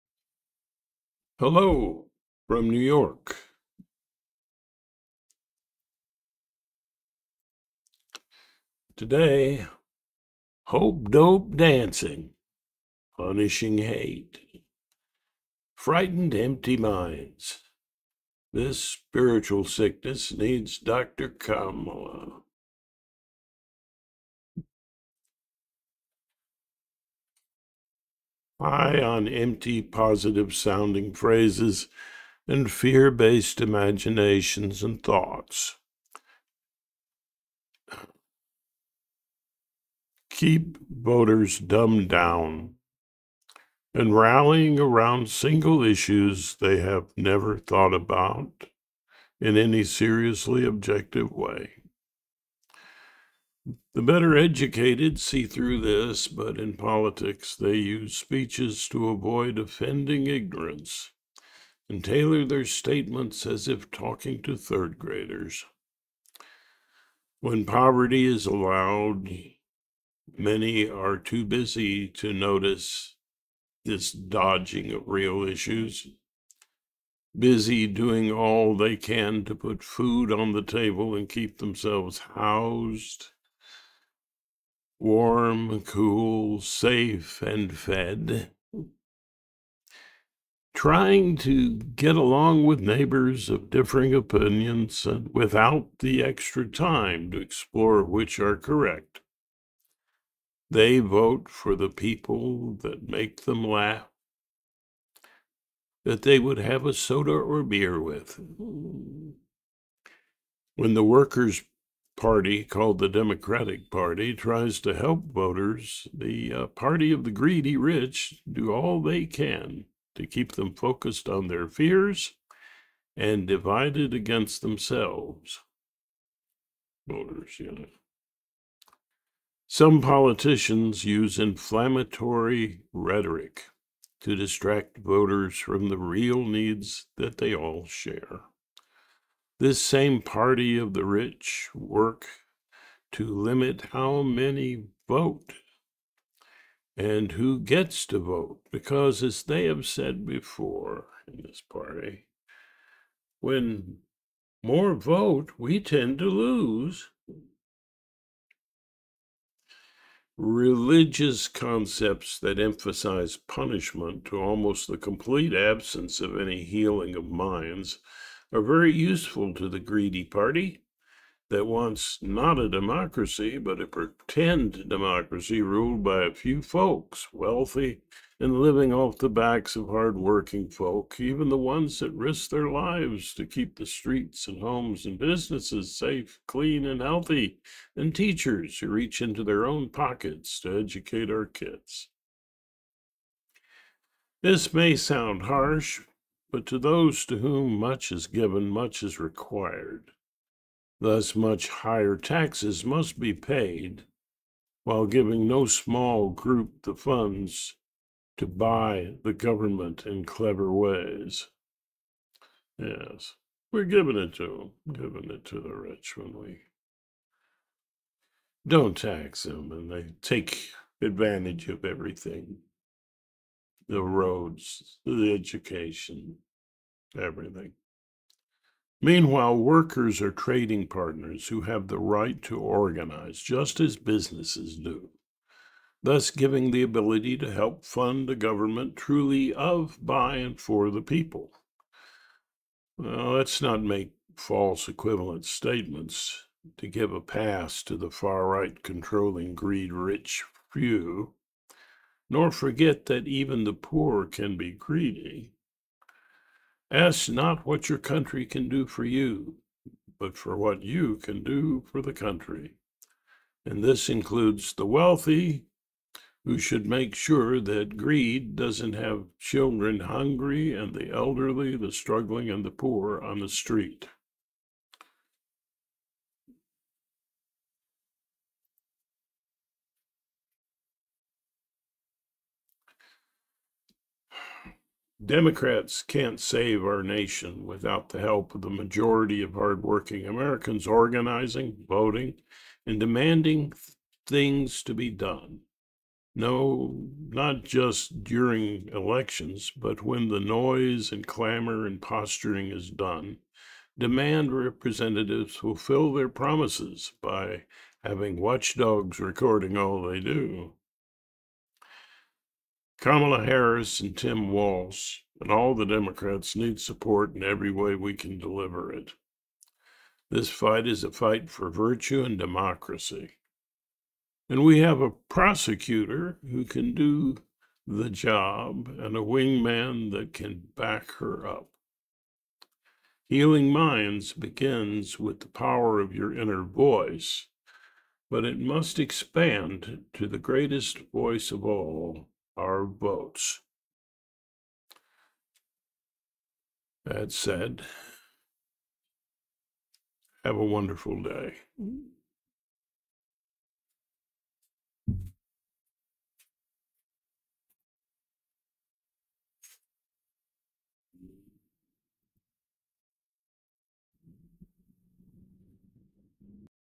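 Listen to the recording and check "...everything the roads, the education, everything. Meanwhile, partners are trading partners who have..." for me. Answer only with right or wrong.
wrong.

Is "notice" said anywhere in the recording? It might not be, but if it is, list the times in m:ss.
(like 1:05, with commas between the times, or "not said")
1:12.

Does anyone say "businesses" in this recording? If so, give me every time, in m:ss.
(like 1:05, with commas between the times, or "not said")
3:05, 3:53.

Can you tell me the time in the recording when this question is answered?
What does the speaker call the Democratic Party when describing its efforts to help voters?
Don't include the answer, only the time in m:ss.
1:51.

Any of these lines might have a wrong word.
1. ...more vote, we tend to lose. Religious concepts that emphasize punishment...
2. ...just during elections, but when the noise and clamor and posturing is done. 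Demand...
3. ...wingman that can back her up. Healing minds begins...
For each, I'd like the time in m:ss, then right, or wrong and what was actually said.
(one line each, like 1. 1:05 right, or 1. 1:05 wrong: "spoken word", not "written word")
1. 2:34 right
2. 4:57 right
3. 5:29 right.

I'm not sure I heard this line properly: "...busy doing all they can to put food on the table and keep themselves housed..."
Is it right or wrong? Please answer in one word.
right.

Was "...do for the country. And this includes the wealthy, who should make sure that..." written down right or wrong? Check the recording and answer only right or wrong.
right.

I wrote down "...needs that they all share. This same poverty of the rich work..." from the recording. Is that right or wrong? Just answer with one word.
wrong.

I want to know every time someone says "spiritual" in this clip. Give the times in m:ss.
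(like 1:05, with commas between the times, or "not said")
0:18.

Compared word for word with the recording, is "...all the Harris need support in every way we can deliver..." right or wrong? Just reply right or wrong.
wrong.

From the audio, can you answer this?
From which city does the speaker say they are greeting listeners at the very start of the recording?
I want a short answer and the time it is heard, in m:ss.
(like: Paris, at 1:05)
New York, at 0:02.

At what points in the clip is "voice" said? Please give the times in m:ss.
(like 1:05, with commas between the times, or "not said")
5:36, 5:41.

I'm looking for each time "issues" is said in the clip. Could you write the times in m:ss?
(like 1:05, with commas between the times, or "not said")
0:45, 1:15.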